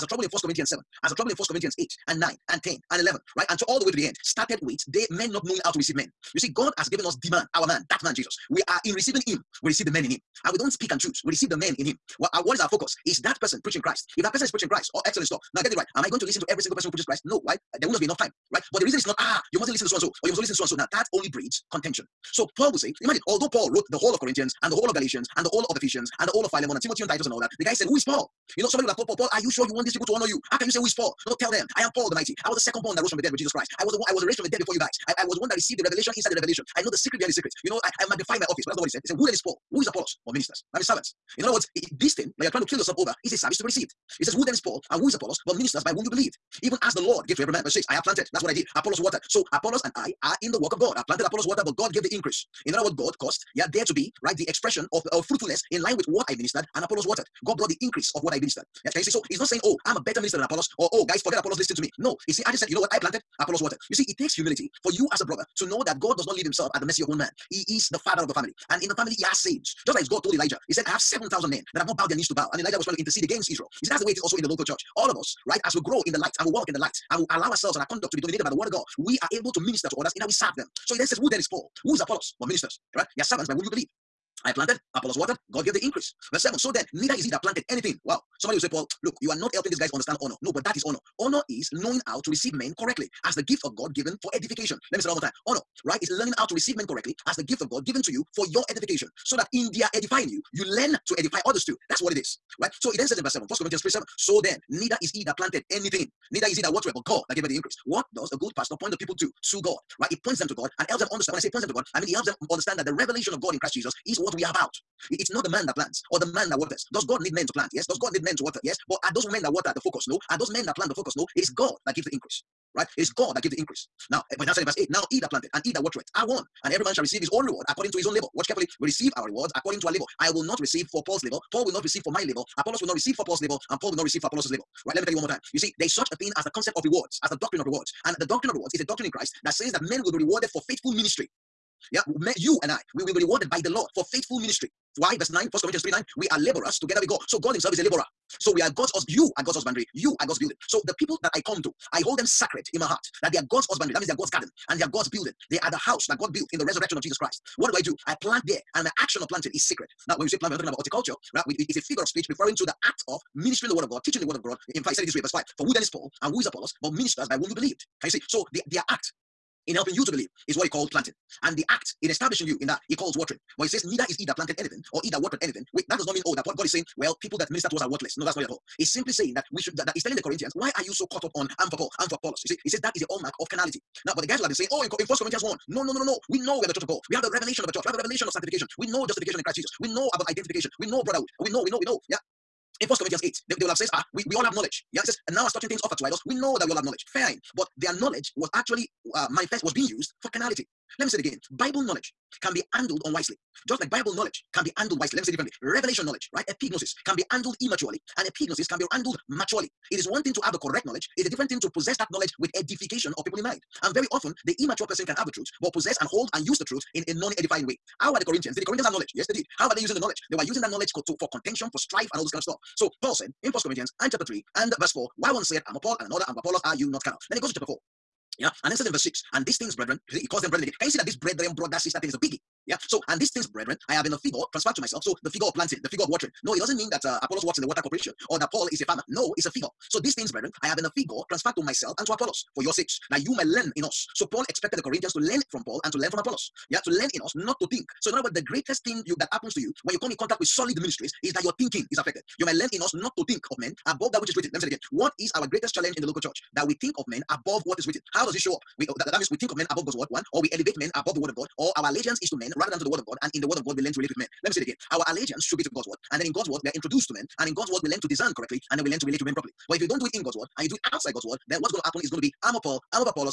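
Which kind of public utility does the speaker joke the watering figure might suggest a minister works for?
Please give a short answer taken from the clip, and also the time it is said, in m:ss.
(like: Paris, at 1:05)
The water corporation, at 3:57.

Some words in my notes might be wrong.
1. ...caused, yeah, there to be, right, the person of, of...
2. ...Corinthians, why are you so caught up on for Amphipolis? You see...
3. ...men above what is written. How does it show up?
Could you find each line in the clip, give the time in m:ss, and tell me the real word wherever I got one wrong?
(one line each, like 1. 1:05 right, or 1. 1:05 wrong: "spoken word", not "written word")
1. 0:53 wrong: "expression", not "person"
2. 3:00 right
3. 4:17 right.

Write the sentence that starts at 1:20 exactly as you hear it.
So he then says, Who then is Paul?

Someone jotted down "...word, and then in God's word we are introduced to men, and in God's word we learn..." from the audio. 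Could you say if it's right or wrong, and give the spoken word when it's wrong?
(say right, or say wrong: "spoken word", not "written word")
right.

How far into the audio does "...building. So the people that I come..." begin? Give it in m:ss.
2:30.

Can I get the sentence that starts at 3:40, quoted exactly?
They were using that knowledge to, for contention, for strife, and all this kind of stuff.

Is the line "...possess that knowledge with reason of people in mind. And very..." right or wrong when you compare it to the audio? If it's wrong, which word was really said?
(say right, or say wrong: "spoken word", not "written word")
wrong: "edification", not "reason".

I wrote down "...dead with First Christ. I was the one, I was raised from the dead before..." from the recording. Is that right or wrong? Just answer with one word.
wrong.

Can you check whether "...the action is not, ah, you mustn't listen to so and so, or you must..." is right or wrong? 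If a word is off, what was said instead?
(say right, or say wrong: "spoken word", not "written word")
wrong: "reason", not "action".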